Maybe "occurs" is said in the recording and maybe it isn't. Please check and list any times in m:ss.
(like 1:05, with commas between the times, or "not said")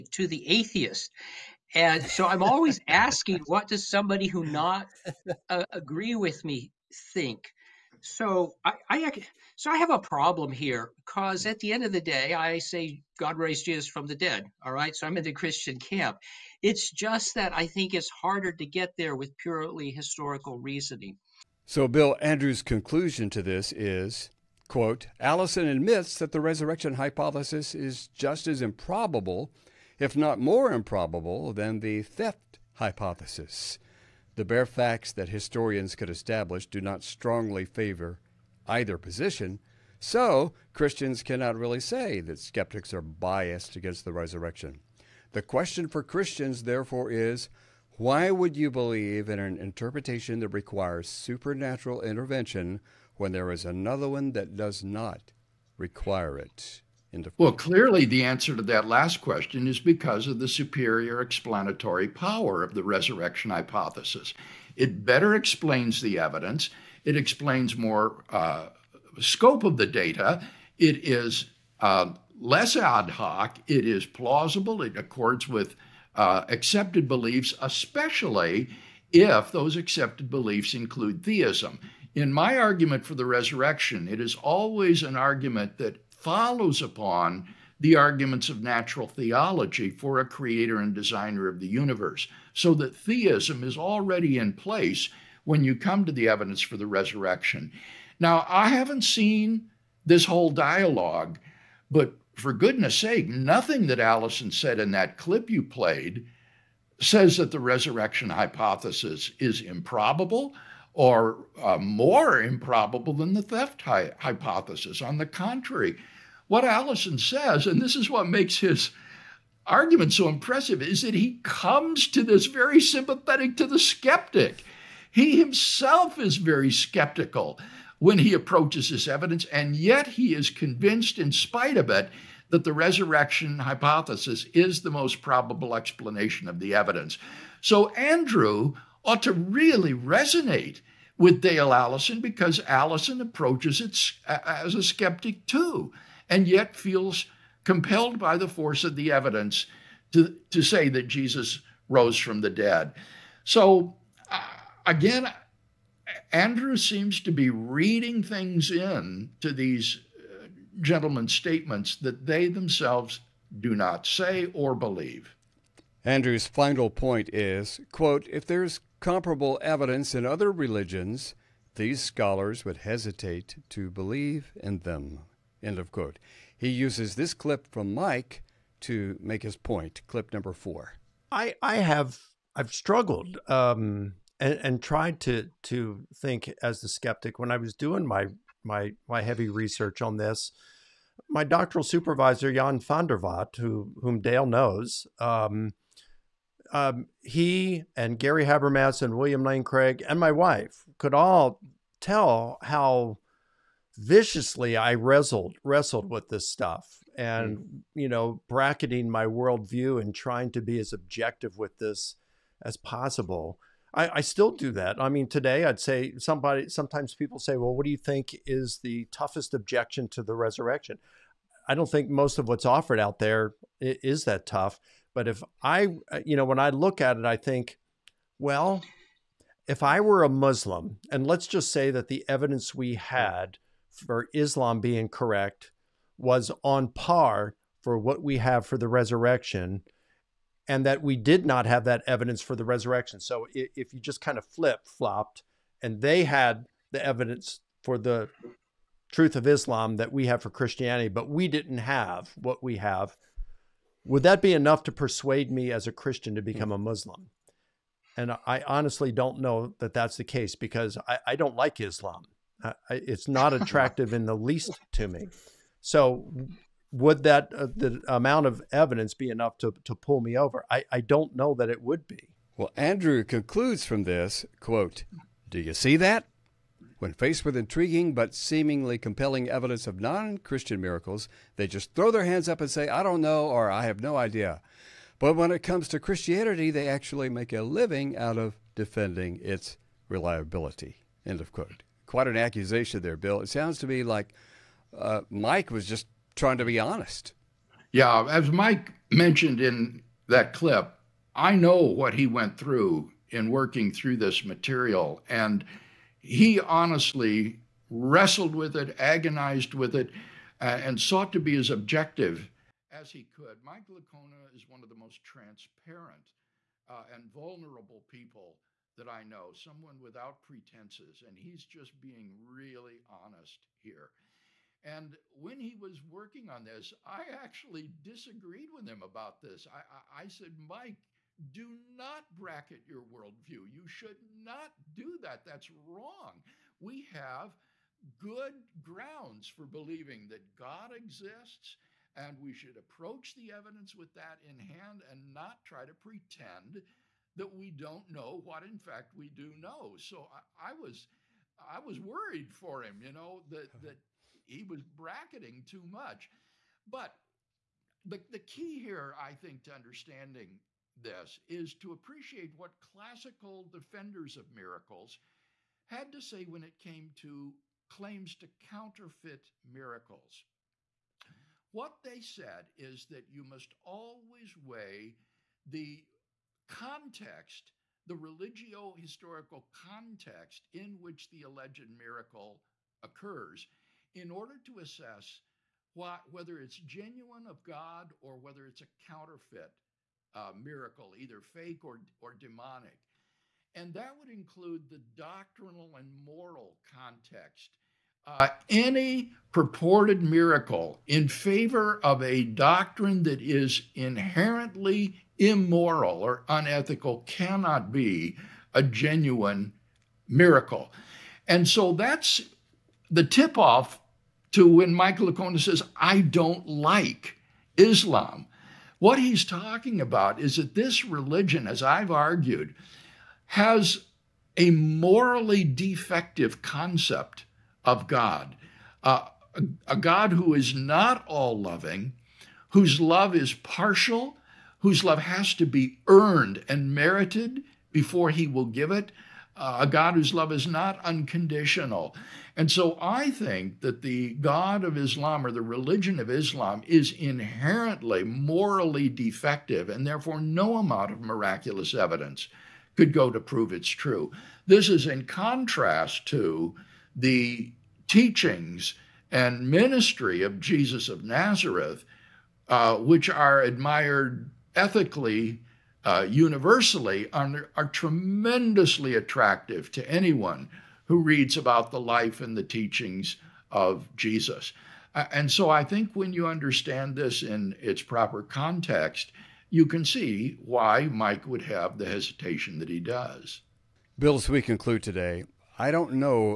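6:23.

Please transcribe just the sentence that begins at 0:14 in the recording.
All right, so I'm in the Christian camp.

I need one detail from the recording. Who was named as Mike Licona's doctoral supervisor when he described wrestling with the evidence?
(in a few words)
Jan van der Watt.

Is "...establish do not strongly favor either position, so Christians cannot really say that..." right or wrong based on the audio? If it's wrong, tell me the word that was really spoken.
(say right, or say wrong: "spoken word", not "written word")
right.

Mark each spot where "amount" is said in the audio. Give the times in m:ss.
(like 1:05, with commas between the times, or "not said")
4:28, 7:30.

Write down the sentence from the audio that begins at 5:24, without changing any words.
And when he was working on this, I actually disagreed with him about this.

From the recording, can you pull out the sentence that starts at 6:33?
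And that would include the doctrinal and moral context.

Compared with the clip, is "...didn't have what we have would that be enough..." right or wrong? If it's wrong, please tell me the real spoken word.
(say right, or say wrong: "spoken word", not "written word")
right.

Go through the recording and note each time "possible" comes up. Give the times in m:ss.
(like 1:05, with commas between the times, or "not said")
3:32.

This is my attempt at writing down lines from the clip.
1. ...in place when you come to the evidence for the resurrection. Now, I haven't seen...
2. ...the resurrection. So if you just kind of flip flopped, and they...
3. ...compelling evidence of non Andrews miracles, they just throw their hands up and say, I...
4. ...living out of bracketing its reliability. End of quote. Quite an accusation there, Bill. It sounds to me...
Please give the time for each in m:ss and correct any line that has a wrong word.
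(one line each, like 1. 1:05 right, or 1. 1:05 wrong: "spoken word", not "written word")
1. 1:34 right
2. 4:02 right
3. 4:38 wrong: "Christian", not "Andrews"
4. 4:47 wrong: "defending", not "bracketing".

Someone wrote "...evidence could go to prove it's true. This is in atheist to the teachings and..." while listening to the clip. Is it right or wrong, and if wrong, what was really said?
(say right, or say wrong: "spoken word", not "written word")
wrong: "contrast", not "atheist".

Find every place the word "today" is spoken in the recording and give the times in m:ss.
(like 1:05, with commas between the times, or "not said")
3:35, 8:05.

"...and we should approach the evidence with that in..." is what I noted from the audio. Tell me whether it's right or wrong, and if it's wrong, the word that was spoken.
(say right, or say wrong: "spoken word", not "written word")
right.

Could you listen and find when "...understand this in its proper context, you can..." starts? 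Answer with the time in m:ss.
7:56.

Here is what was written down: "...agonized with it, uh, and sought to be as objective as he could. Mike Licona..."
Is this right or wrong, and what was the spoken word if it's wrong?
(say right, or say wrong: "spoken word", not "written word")
right.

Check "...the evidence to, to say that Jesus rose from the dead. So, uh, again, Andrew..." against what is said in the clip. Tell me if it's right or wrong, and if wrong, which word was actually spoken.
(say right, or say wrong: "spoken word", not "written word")
right.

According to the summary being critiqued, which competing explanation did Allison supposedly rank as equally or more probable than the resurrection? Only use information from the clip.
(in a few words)
The theft hypothesis.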